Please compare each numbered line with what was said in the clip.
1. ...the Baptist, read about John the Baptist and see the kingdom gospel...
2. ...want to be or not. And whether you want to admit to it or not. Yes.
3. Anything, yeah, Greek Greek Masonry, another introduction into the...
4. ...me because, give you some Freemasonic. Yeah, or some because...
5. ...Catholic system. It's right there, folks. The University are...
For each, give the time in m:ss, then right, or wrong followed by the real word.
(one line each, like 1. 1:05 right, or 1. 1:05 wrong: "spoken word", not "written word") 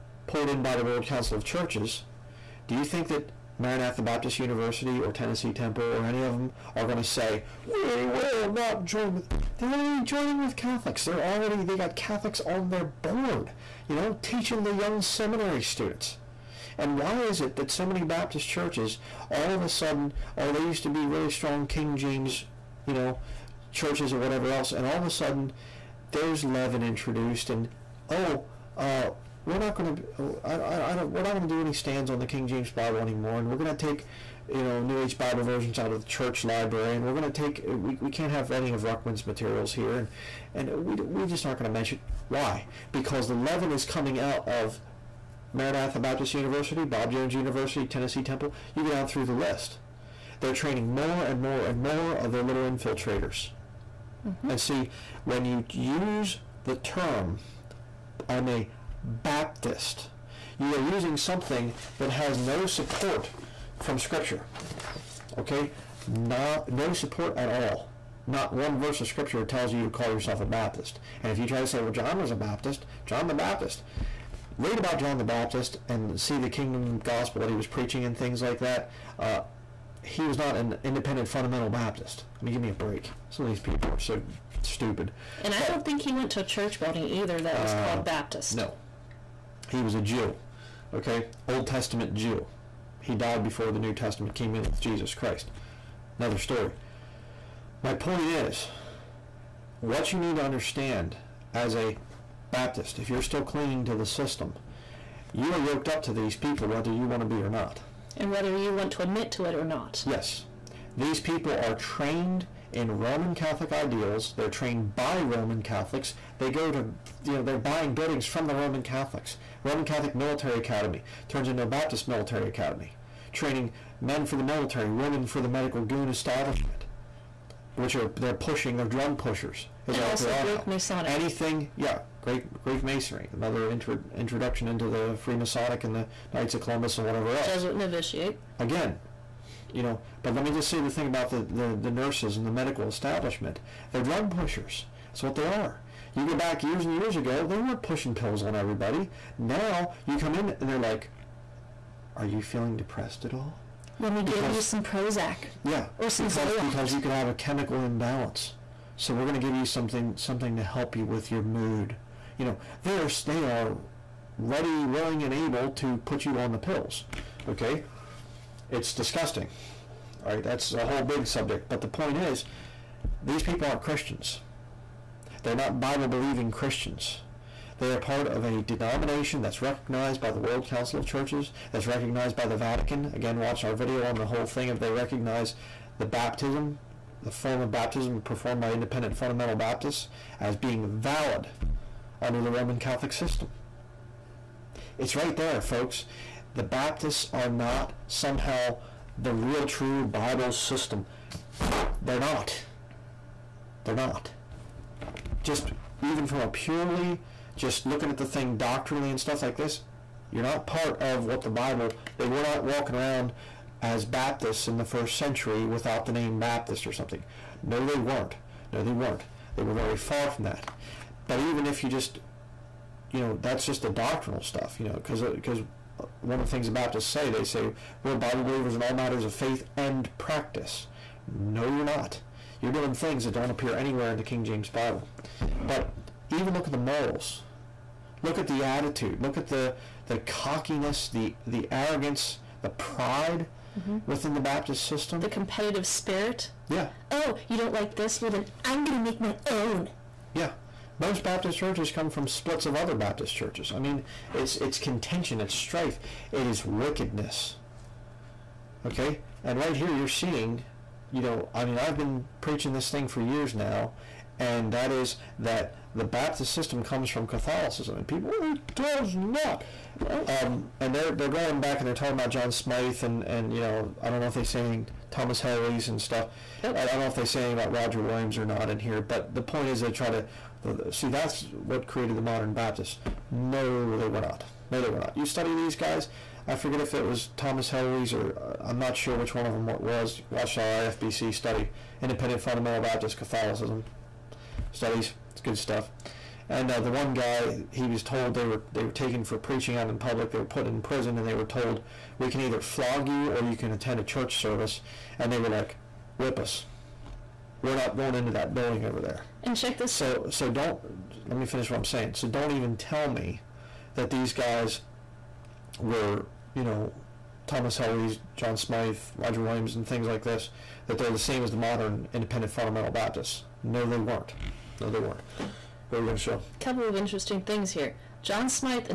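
1. 1:13 right
2. 1:47 right
3. 2:11 right
4. 2:34 wrong: "Prozac", not "Freemasonic"
5. 3:12 wrong: "Baptists", not "University".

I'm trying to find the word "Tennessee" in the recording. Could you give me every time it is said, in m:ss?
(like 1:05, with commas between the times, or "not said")
0:05, 0:47.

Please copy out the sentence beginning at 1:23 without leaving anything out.
Some of these people are so stupid.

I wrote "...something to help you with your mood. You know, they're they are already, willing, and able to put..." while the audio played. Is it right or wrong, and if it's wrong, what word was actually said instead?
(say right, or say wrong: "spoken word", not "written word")
wrong: "ready", not "already".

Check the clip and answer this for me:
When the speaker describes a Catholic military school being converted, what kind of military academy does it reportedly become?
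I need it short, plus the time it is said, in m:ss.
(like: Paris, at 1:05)
Baptist Military Academy, at 2:01.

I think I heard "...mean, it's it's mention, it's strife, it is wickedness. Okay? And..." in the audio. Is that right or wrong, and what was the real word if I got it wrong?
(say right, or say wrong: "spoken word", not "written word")
wrong: "contention", not "mention".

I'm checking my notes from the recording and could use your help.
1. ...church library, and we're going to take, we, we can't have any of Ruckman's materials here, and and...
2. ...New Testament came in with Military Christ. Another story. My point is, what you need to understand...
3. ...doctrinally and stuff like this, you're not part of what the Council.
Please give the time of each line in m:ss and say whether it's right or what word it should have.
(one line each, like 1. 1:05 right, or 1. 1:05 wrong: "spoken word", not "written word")
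1. 0:36 right
2. 1:33 wrong: "Jesus", not "Military"
3. 3:28 wrong: "Bible", not "Council".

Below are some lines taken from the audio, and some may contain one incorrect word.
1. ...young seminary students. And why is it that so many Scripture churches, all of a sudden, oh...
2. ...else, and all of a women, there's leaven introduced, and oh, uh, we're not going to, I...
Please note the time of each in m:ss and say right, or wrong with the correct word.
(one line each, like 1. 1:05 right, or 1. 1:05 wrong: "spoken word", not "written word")
1. 0:14 wrong: "Baptist", not "Scripture"
2. 0:24 wrong: "sudden", not "women".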